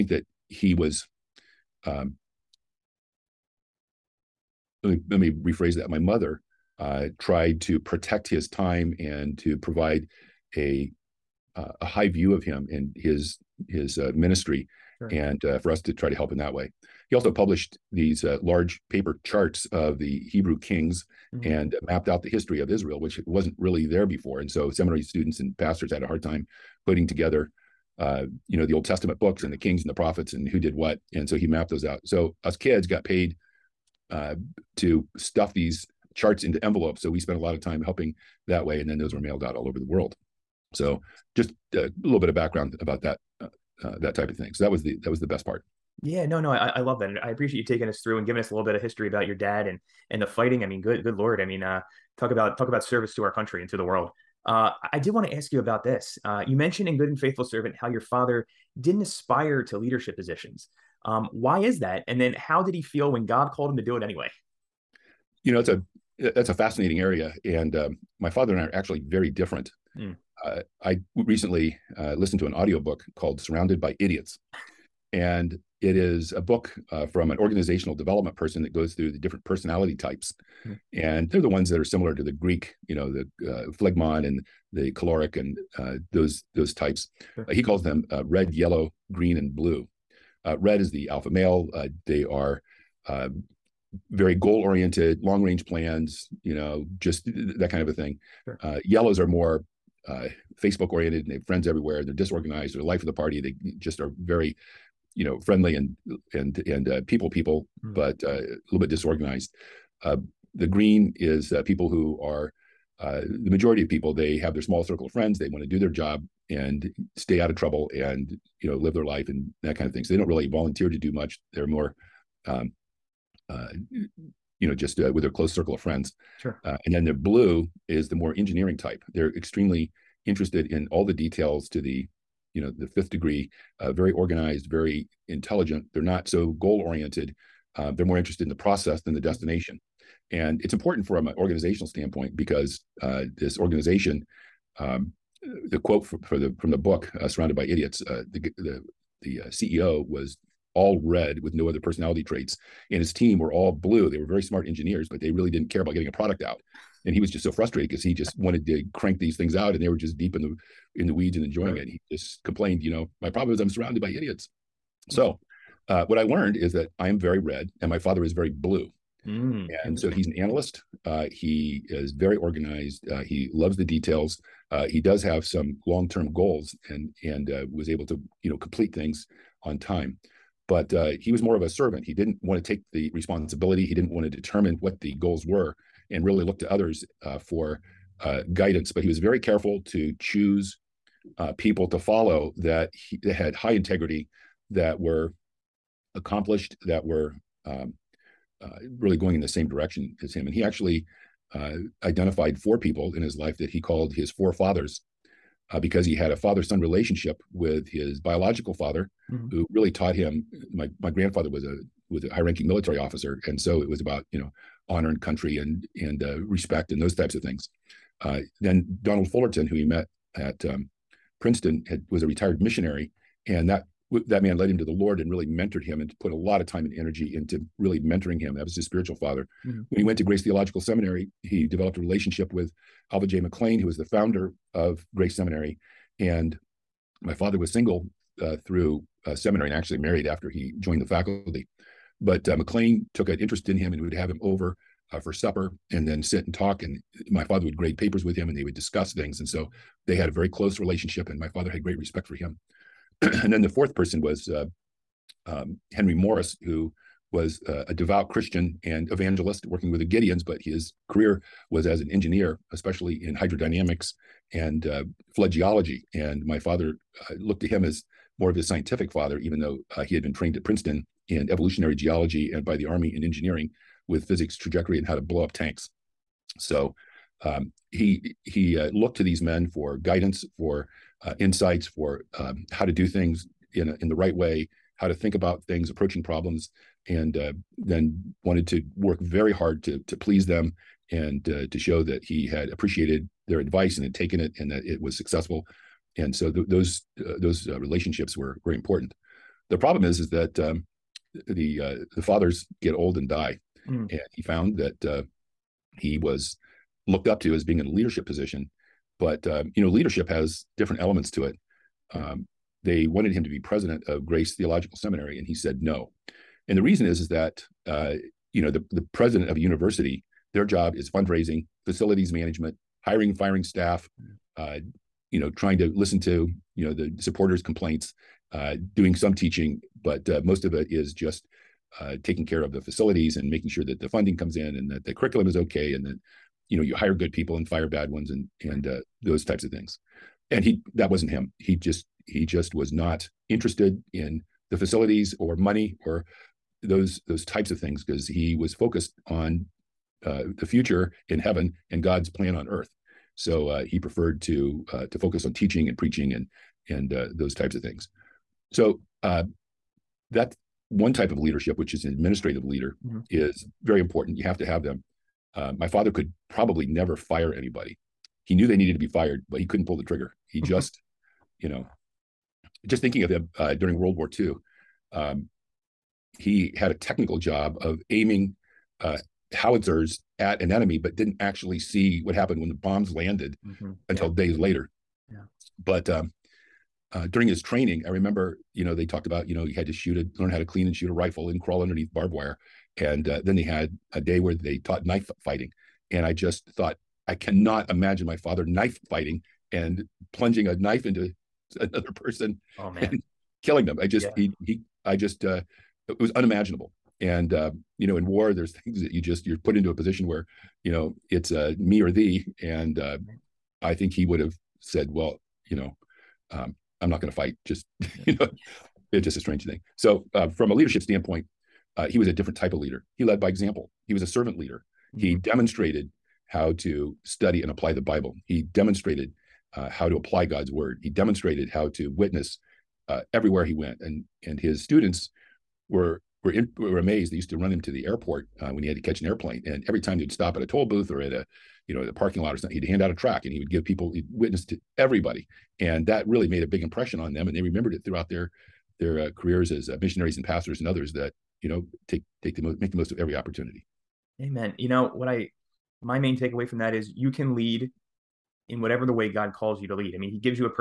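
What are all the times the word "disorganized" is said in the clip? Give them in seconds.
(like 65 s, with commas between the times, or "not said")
102 s, 108 s.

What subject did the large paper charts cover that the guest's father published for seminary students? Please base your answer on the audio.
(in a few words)
Hebrew kings.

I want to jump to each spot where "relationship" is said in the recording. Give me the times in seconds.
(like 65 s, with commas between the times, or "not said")
206 s, 231 s, 250 s, 297 s.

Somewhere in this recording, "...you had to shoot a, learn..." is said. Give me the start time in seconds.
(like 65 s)
389 s.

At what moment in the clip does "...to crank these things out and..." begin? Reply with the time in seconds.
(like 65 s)
158 s.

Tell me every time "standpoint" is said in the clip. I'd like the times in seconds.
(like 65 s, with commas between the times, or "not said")
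141 s, 421 s.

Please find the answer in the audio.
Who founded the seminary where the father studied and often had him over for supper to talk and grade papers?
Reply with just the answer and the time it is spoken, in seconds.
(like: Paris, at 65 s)
Alva J. McClain, at 233 s.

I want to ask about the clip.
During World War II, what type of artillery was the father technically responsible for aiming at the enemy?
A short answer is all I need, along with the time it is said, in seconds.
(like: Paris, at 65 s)
howitzers, at 379 s.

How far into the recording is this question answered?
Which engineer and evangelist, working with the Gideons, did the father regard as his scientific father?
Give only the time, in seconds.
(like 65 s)
255 s.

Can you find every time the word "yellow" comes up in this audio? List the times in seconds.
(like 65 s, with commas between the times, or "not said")
88 s, 98 s.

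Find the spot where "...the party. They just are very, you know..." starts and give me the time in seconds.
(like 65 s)
103 s.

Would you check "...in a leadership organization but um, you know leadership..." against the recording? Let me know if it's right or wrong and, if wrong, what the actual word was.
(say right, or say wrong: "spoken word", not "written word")
wrong: "position", not "organization".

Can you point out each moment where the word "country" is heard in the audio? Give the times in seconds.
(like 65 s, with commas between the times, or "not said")
53 s, 215 s.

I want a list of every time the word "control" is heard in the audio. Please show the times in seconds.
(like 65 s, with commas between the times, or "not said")
not said.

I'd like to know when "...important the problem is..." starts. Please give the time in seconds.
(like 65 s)
298 s.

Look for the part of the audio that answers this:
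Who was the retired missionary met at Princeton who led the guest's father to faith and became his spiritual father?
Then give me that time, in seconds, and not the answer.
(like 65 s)
219 s.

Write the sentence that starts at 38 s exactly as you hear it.
And then those were mailed out all over the world.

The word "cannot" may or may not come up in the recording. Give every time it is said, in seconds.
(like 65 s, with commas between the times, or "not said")
397 s.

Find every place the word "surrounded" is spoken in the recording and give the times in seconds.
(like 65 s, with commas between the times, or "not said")
73 s, 147 s, 163 s.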